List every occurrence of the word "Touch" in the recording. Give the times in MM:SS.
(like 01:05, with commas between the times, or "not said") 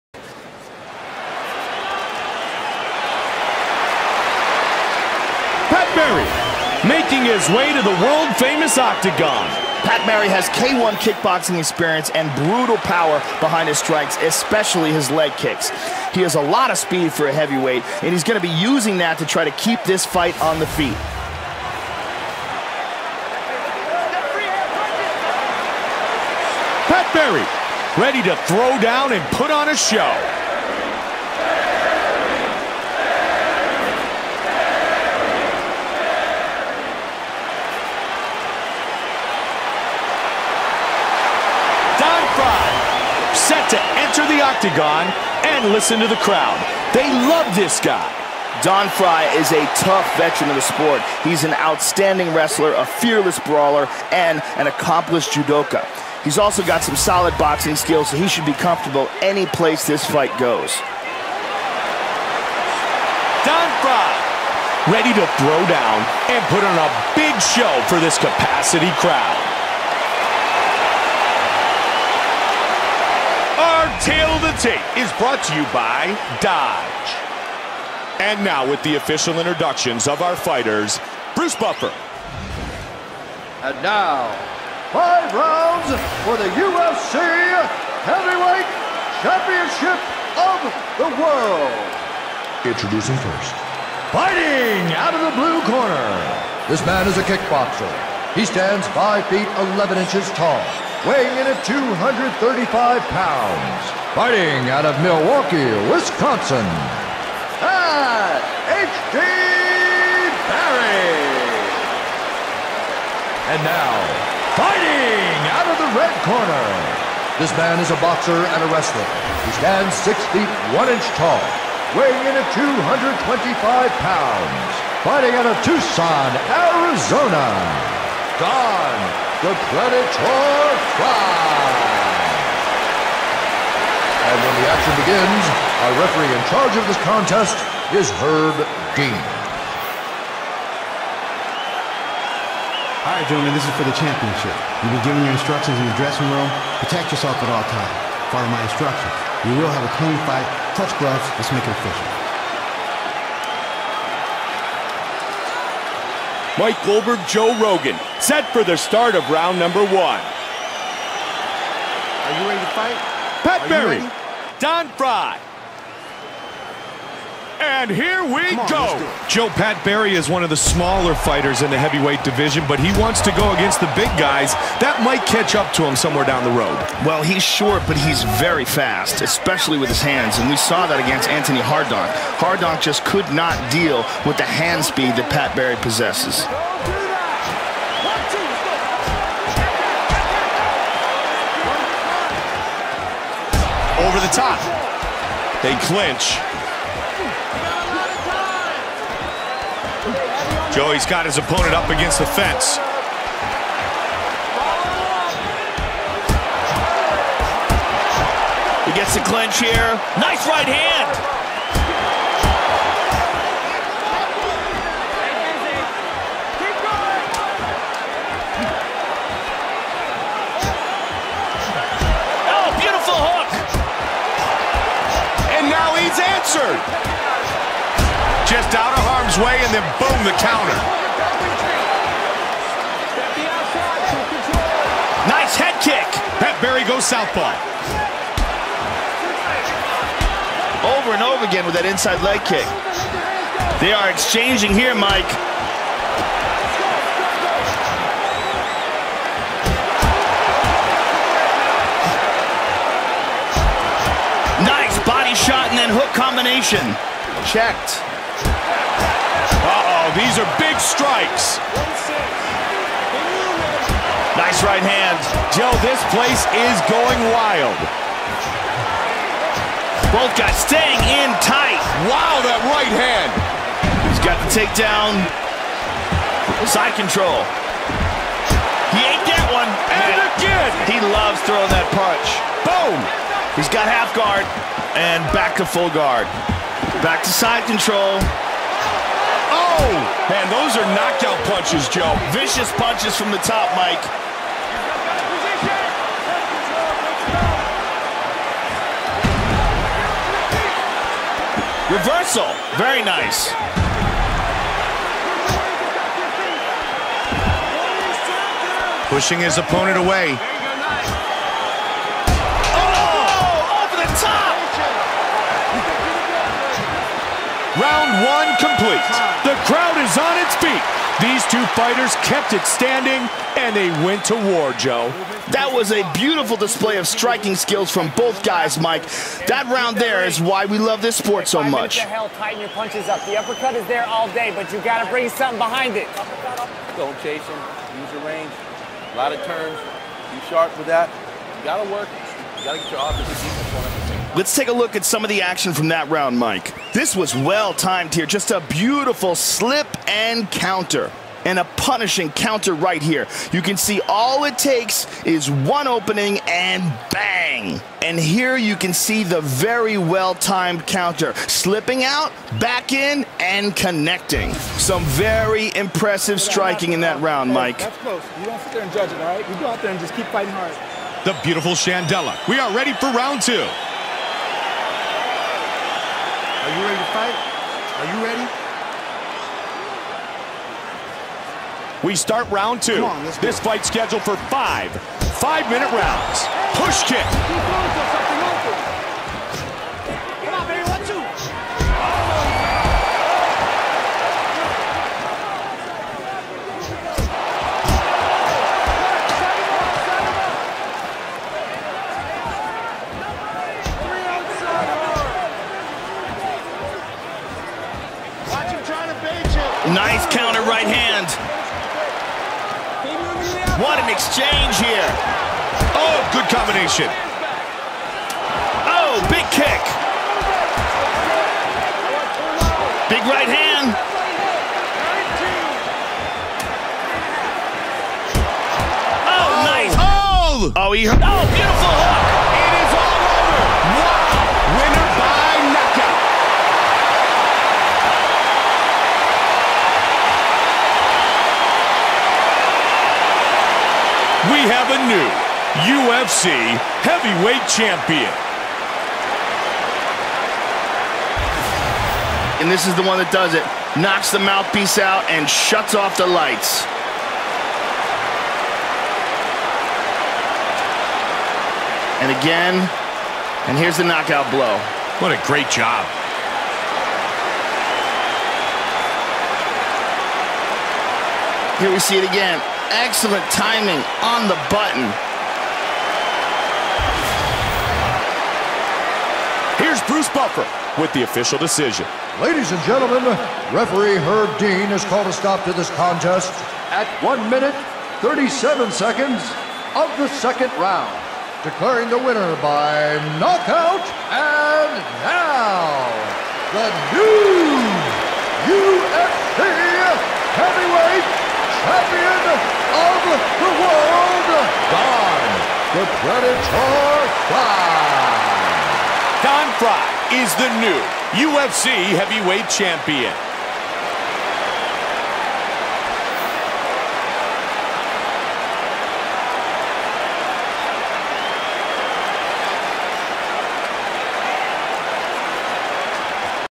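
02:30.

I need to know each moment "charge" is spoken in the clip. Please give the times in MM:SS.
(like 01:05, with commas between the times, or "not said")
02:16.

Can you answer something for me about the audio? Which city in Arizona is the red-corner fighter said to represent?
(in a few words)
Tucson.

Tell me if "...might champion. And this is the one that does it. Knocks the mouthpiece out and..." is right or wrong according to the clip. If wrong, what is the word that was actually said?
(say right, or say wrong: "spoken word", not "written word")
wrong: "heavyweight", not "might".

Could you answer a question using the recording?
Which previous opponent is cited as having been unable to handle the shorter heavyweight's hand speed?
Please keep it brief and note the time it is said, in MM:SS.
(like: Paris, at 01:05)
Antoni Hardonk, at 03:01.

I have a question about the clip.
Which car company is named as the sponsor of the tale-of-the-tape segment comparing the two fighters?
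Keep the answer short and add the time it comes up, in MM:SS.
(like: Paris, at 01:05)
Dodge, at 01:16.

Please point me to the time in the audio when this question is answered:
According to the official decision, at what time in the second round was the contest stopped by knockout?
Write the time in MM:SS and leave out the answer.
08:07.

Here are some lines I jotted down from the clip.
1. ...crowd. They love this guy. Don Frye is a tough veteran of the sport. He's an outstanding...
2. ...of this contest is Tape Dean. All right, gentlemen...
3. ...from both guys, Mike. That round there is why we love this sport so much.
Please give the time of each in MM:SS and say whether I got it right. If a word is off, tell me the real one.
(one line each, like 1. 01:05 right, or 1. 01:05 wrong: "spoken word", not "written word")
1. 00:46 right
2. 02:16 wrong: "Herb", not "Tape"
3. 05:27 right.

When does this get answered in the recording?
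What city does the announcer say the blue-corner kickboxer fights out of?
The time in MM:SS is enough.
01:45.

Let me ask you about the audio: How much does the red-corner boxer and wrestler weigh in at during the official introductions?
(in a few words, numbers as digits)
225 pounds.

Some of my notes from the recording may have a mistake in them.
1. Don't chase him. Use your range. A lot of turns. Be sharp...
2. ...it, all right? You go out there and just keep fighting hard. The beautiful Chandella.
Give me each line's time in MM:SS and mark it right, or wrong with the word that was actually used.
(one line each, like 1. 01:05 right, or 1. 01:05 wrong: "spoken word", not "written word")
1. 05:36 right
2. 06:09 right.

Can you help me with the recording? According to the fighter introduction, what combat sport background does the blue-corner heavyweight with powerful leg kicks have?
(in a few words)
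K1 kickboxing.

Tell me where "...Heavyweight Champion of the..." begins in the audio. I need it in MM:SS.
08:20.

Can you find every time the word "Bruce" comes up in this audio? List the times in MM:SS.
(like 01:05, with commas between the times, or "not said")
01:21, 08:00.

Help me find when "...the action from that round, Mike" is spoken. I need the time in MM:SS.
05:45.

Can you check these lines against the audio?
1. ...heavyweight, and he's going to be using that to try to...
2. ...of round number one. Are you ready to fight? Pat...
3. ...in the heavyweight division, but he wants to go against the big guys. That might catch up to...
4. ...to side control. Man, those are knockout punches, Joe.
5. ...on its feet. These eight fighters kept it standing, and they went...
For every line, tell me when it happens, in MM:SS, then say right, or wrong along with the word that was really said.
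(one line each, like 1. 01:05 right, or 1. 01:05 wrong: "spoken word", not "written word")
1. 00:17 right
2. 02:39 right
3. 02:51 right
4. 04:47 right
5. 05:20 wrong: "two", not "eight".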